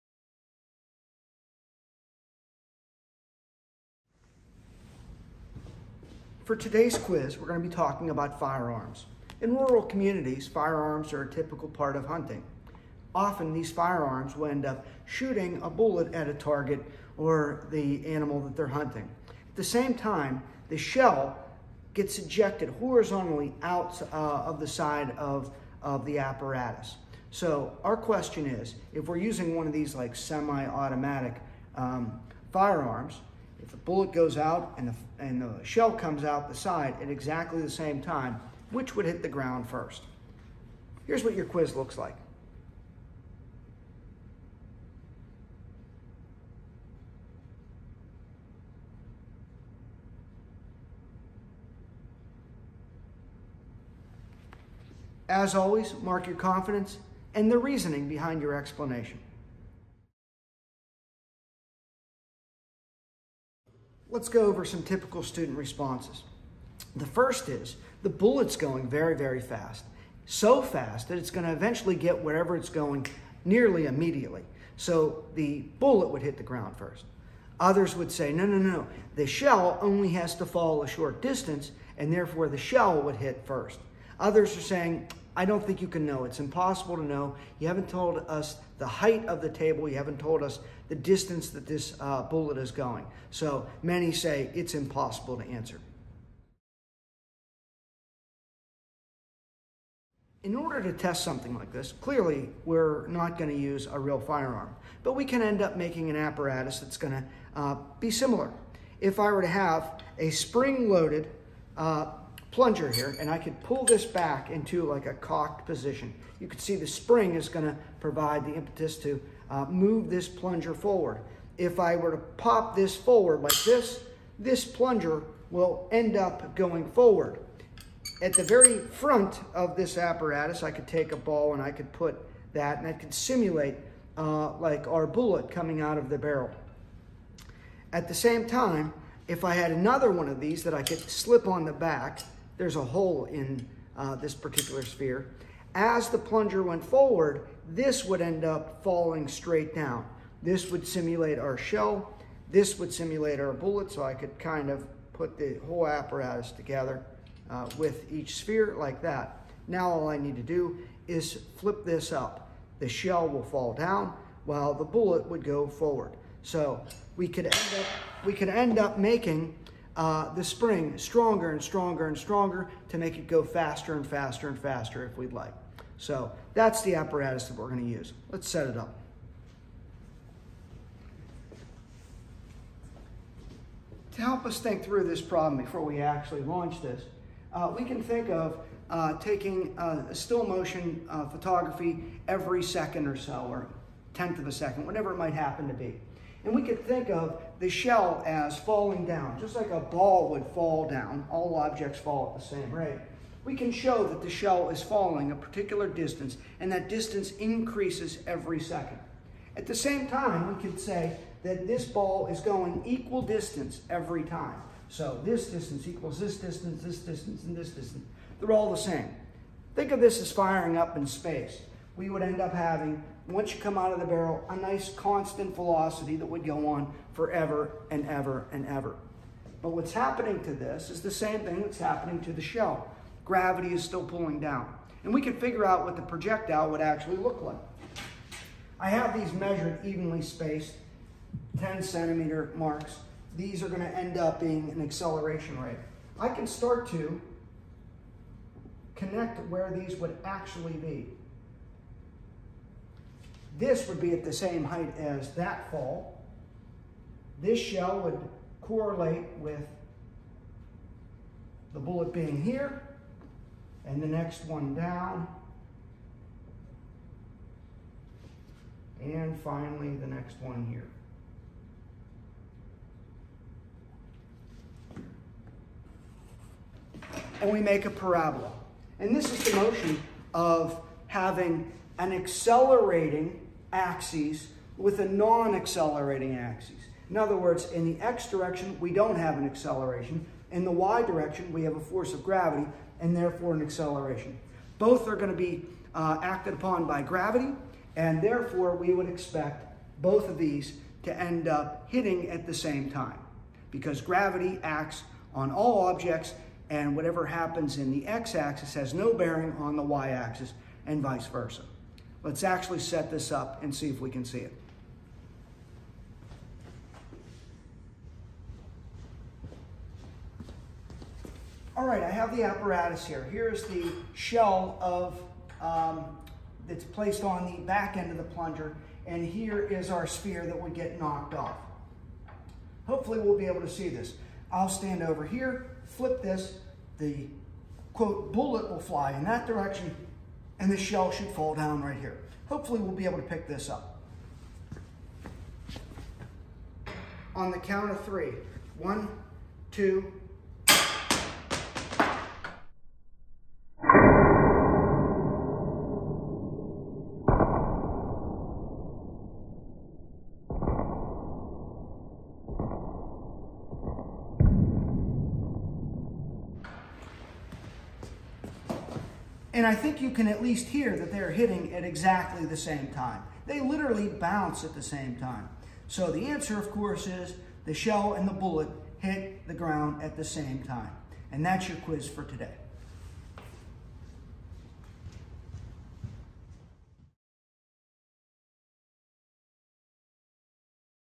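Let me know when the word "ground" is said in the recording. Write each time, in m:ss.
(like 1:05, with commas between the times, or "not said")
0:39, 1:16, 6:19.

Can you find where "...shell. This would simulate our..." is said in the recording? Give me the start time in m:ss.
2:31.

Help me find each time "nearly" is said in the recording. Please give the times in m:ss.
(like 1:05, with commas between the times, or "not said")
1:13.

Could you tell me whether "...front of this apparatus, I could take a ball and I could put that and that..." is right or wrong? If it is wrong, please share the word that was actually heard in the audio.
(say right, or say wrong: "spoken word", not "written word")
right.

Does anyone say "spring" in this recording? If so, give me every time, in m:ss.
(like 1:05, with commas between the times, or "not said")
1:50, 1:56, 2:50.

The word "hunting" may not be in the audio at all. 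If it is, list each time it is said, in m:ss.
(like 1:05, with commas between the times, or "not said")
0:12, 0:18.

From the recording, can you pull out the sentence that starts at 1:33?
So many say it's impossible to answer.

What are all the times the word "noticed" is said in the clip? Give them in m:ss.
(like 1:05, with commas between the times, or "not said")
not said.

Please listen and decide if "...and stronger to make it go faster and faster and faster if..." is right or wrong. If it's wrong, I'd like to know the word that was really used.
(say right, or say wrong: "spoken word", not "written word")
right.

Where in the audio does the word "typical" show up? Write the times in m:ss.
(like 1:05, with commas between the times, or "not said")
0:11, 1:04.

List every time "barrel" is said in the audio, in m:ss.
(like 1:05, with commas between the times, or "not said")
2:16, 3:44.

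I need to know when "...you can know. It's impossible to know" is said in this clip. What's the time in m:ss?
1:25.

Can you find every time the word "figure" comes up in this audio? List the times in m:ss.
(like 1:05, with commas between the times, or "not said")
3:55.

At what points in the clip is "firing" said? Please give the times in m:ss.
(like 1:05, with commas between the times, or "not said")
3:40.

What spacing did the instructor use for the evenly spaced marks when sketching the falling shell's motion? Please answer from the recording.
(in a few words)
10 centimeters.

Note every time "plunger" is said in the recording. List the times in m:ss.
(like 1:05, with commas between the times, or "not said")
1:52, 2:00, 2:04, 2:26, 5:28.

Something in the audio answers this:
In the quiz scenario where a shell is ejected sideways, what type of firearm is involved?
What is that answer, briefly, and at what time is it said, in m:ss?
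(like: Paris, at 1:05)
Semi-automatic, at 0:30.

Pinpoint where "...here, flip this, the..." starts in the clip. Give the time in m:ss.
5:35.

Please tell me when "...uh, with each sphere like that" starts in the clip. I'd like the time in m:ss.
2:37.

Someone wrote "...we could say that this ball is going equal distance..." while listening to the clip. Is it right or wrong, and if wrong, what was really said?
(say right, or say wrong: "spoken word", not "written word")
right.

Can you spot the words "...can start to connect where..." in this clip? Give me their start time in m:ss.
4:06.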